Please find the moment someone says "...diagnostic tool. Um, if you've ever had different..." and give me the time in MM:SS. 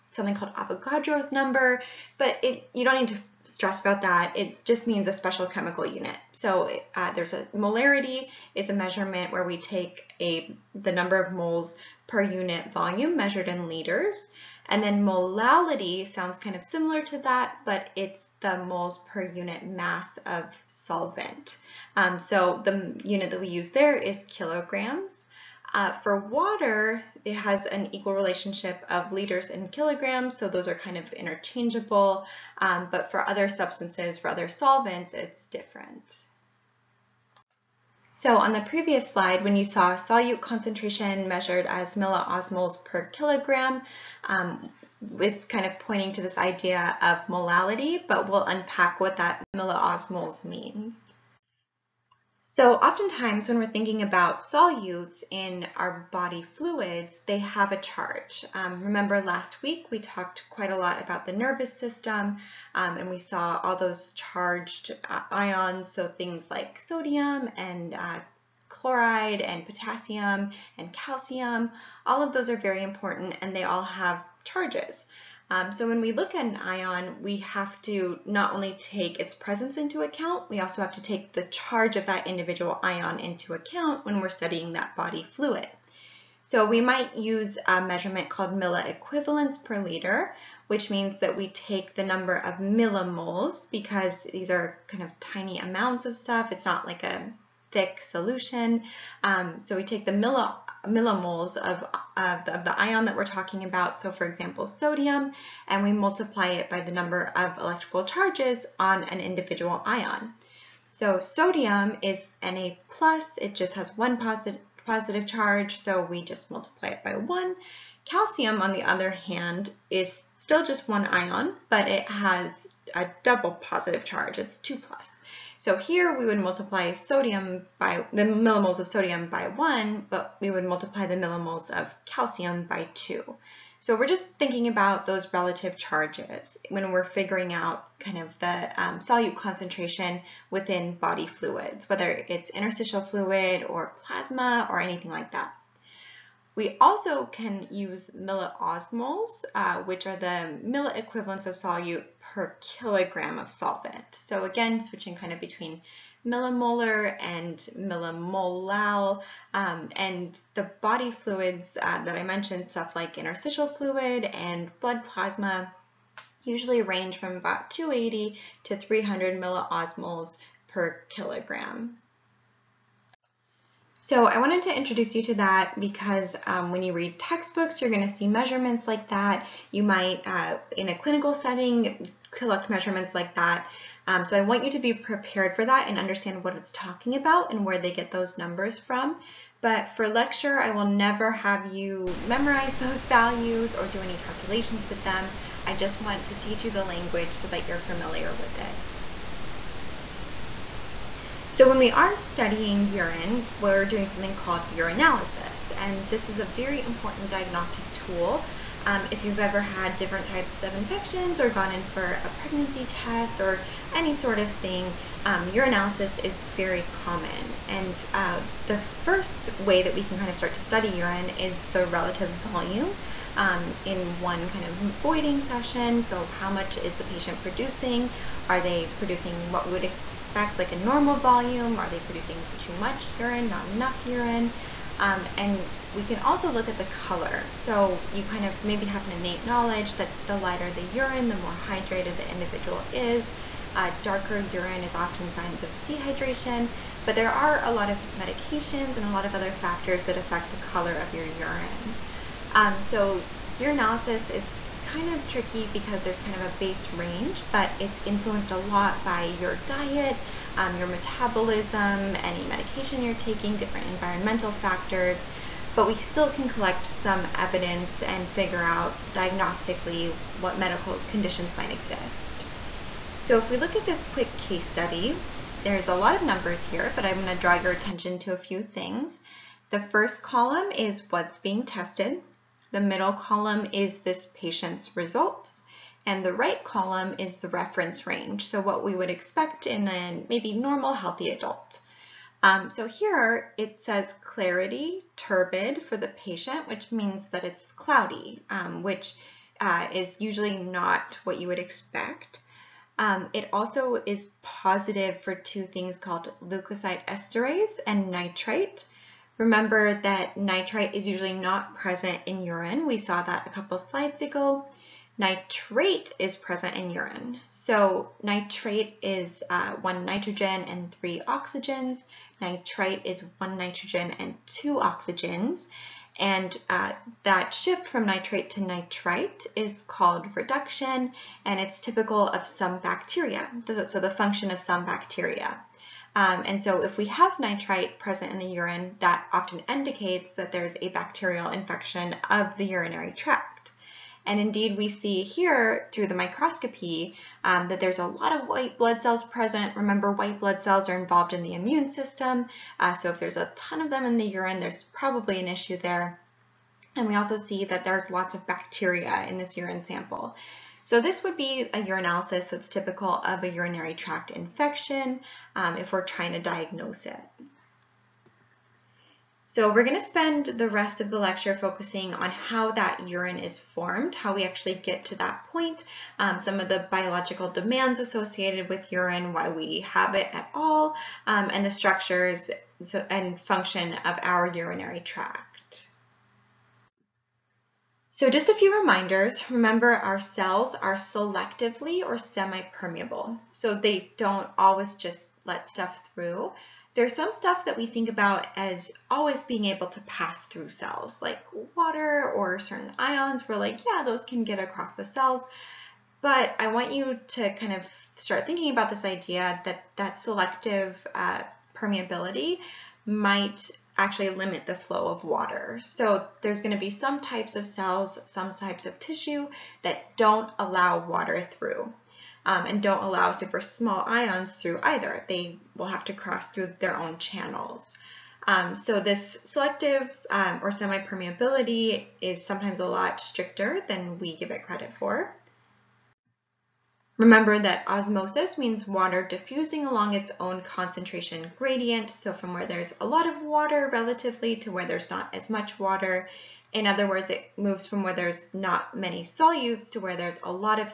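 03:27.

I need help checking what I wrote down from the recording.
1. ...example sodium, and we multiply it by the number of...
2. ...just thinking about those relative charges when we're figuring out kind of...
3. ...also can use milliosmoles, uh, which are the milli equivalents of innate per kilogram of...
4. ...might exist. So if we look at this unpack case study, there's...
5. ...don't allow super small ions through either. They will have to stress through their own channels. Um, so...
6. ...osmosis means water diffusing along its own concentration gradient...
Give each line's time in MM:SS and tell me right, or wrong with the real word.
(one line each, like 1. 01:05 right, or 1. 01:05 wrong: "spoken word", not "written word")
1. 01:44 right
2. 02:14 right
3. 02:26 wrong: "solute", not "innate"
4. 04:31 wrong: "quick", not "unpack"
5. 07:02 wrong: "cross", not "stress"
6. 07:17 right.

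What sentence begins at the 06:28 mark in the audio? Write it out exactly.
So just a few reminders, remember our cells are selectively or semi-permeable.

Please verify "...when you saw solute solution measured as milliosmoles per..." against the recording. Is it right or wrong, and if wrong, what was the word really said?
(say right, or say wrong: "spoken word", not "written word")
wrong: "concentration", not "solution".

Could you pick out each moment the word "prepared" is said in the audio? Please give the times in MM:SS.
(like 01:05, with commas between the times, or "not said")
03:04.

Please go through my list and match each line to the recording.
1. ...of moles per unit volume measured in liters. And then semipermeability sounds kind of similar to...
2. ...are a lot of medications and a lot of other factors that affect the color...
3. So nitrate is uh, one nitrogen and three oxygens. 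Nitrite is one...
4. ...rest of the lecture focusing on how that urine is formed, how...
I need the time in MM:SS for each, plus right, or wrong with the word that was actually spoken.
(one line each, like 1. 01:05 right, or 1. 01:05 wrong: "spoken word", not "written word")
1. 00:11 wrong: "molality", not "semipermeability"
2. 04:07 right
3. 05:17 right
4. 06:10 right.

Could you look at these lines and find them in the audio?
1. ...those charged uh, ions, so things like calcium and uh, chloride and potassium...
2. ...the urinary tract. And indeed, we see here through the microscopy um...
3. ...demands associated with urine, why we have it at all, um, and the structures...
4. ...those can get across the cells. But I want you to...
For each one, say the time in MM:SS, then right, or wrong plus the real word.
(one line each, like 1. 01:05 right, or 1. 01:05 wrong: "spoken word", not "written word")
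1. 01:03 wrong: "sodium", not "calcium"
2. 05:42 right
3. 06:17 right
4. 06:44 right.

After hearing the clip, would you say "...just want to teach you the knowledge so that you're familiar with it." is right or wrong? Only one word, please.
wrong.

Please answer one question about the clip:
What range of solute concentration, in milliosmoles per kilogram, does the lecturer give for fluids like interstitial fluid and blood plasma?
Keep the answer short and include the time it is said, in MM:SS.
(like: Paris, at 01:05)
280 to 300, at 02:47.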